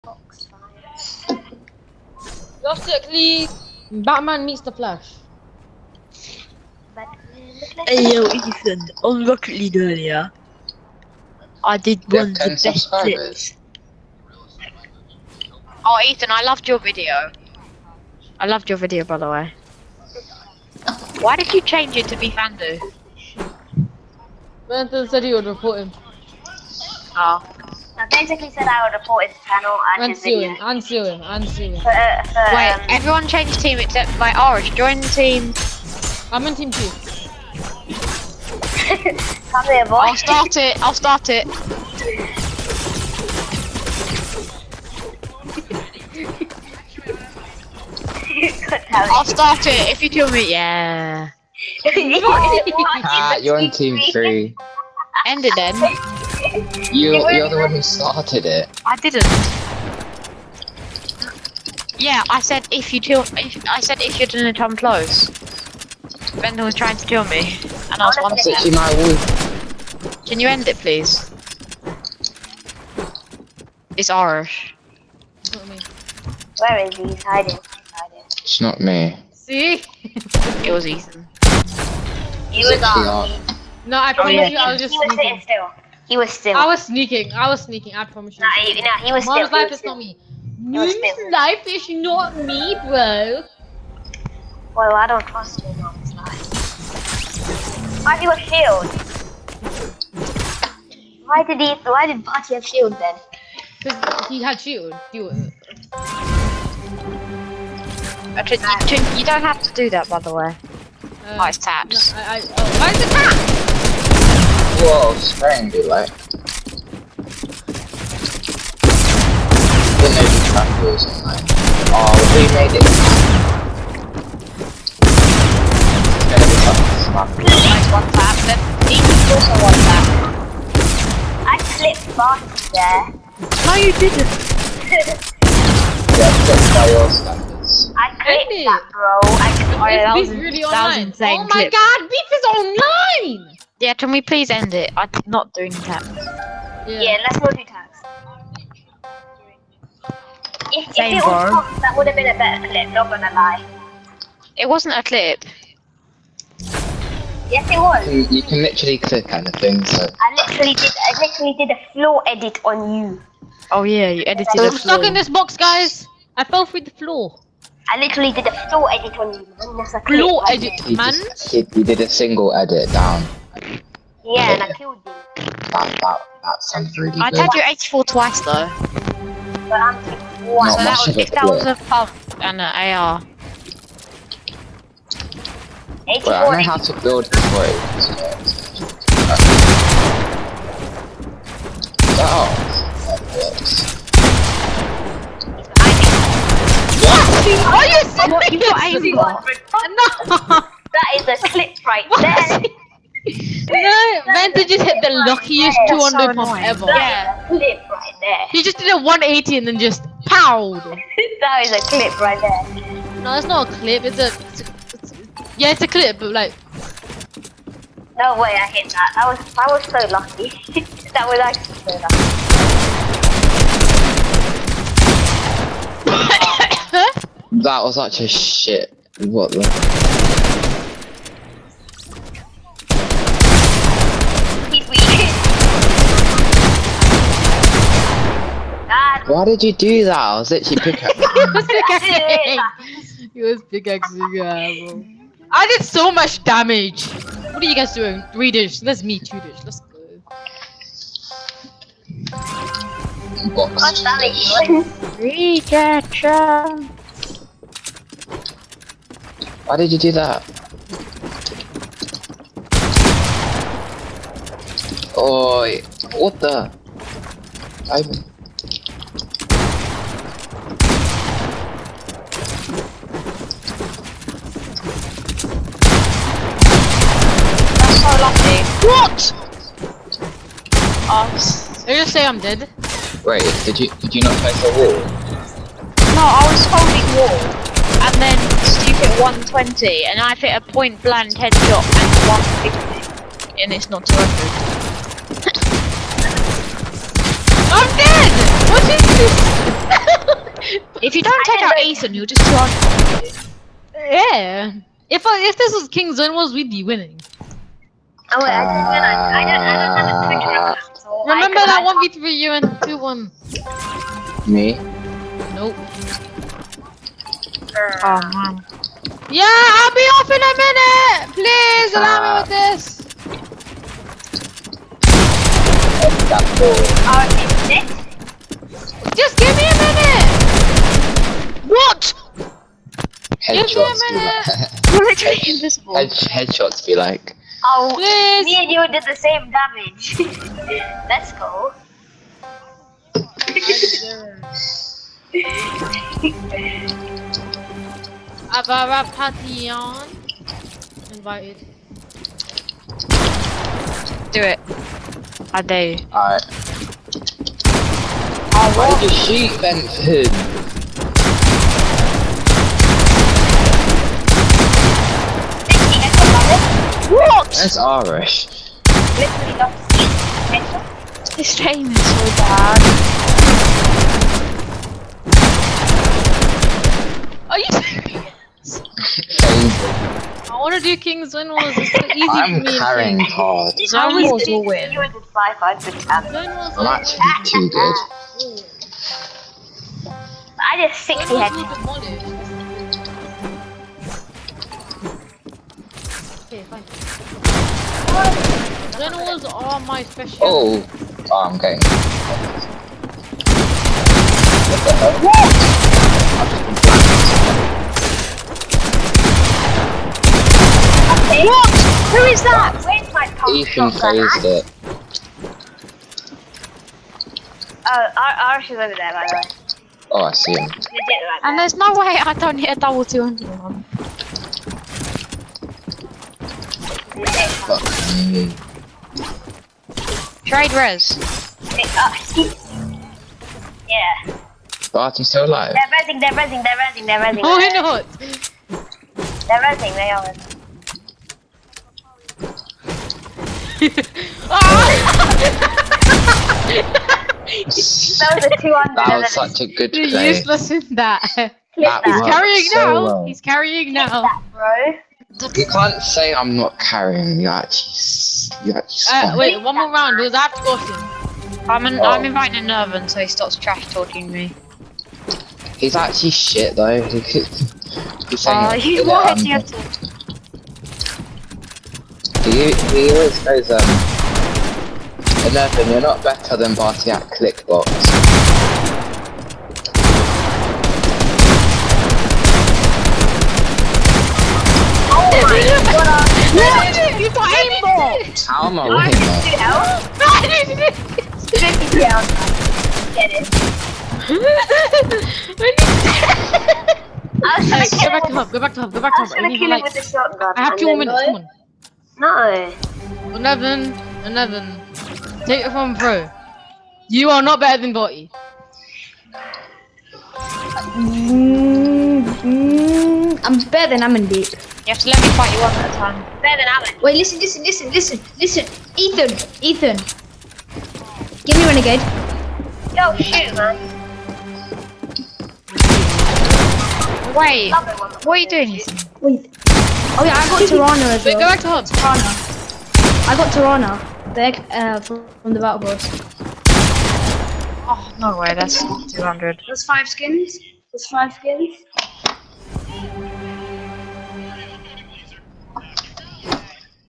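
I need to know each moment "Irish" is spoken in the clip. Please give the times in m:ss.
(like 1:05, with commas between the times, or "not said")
1:14, 6:07.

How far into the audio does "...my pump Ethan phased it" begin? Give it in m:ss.
6:53.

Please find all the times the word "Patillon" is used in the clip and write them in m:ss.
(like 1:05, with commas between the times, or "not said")
5:49.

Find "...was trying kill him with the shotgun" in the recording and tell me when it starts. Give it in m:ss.
8:19.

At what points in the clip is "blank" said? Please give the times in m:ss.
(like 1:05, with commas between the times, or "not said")
4:51.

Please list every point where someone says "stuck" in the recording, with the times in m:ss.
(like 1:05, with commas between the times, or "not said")
2:44.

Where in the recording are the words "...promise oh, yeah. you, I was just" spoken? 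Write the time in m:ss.
1:24.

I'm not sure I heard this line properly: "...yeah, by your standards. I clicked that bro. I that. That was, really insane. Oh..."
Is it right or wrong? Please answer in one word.
right.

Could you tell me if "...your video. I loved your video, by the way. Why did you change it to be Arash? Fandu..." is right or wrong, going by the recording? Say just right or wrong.
wrong.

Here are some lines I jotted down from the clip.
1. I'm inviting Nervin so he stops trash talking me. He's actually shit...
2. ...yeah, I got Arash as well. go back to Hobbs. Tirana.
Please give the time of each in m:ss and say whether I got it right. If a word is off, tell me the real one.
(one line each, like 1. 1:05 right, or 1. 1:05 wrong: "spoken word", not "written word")
1. 7:42 right
2. 8:50 wrong: "Tirana", not "Arash".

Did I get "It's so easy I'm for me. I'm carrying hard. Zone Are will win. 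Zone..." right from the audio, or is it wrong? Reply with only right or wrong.
wrong.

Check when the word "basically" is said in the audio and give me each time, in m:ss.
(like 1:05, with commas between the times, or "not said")
0:02, 0:28.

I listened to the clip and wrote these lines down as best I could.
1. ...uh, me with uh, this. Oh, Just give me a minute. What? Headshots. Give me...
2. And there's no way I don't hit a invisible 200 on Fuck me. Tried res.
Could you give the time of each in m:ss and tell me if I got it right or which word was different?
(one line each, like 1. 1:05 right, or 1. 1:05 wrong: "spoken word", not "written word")
1. 5:22 right
2. 7:01 wrong: "double", not "invisible".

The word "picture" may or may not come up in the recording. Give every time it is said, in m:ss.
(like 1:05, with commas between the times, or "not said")
5:10.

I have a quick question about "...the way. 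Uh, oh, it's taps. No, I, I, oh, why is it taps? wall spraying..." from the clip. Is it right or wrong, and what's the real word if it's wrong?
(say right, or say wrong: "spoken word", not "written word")
right.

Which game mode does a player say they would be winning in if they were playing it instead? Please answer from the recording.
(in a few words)
King's Zone.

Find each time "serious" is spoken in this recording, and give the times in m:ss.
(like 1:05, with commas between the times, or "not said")
3:19, 6:17.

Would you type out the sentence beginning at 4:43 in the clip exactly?
Wait, did you did you not face a wall?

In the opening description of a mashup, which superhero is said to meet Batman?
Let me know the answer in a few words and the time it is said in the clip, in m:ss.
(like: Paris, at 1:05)
The Flash, at 0:04.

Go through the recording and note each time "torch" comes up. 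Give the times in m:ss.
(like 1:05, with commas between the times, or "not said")
not said.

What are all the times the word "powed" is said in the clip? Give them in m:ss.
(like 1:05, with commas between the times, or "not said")
3:30.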